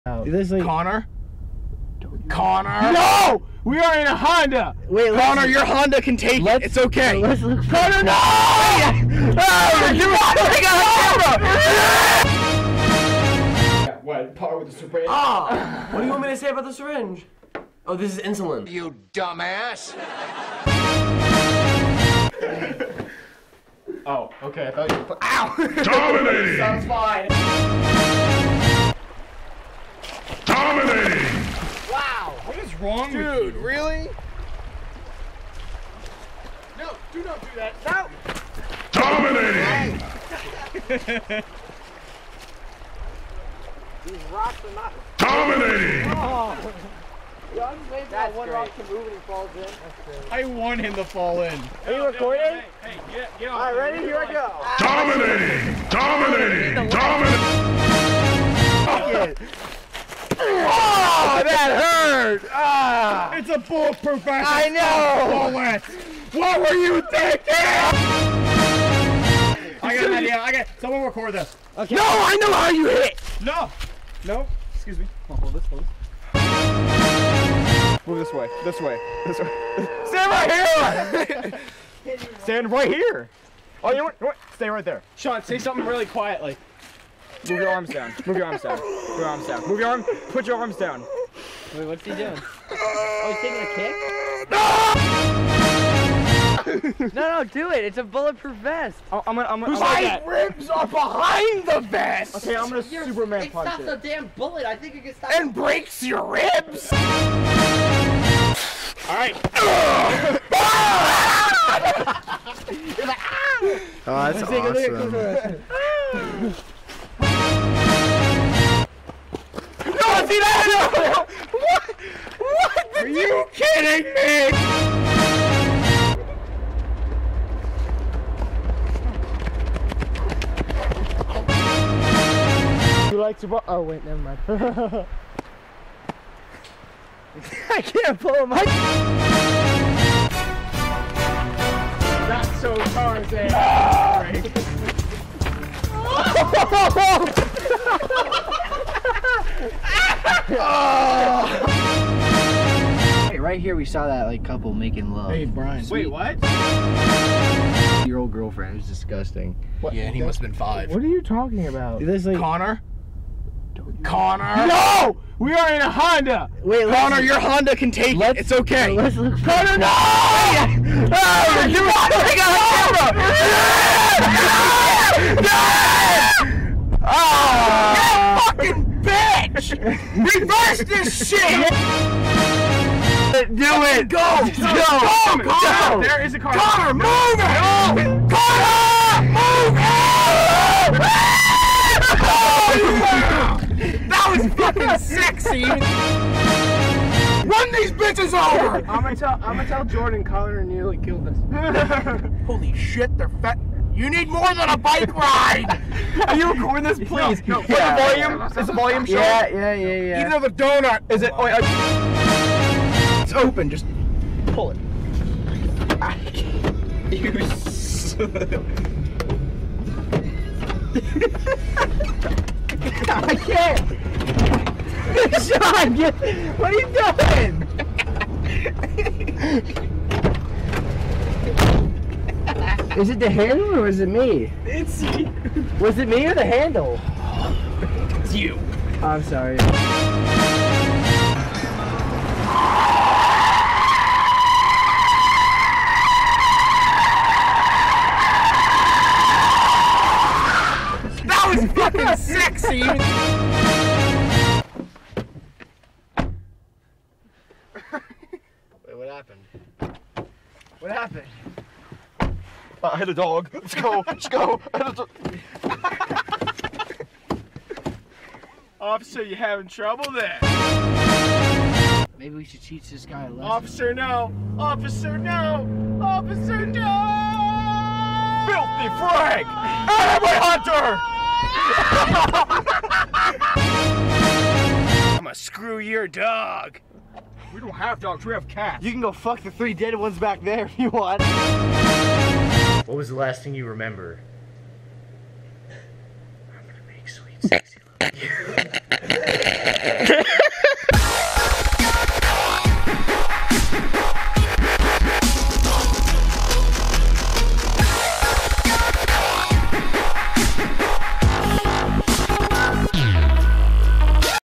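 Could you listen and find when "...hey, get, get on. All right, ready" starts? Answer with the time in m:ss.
0:52.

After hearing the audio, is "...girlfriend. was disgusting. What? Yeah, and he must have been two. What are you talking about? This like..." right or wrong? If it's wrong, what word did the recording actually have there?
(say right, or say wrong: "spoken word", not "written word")
wrong: "five", not "two".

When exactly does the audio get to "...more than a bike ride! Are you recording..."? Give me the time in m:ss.
3:24.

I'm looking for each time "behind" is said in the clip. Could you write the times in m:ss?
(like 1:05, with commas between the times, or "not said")
1:40.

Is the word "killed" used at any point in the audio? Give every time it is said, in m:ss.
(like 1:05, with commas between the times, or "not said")
3:20.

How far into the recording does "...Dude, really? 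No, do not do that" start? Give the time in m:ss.
0:33.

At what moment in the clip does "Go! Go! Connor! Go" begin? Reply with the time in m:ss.
3:04.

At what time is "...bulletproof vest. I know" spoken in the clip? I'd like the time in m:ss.
1:03.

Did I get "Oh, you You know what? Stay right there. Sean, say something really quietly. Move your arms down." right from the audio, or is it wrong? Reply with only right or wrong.
right.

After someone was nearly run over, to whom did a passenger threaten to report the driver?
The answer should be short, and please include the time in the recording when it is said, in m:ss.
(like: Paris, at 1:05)
Jordan, at 3:19.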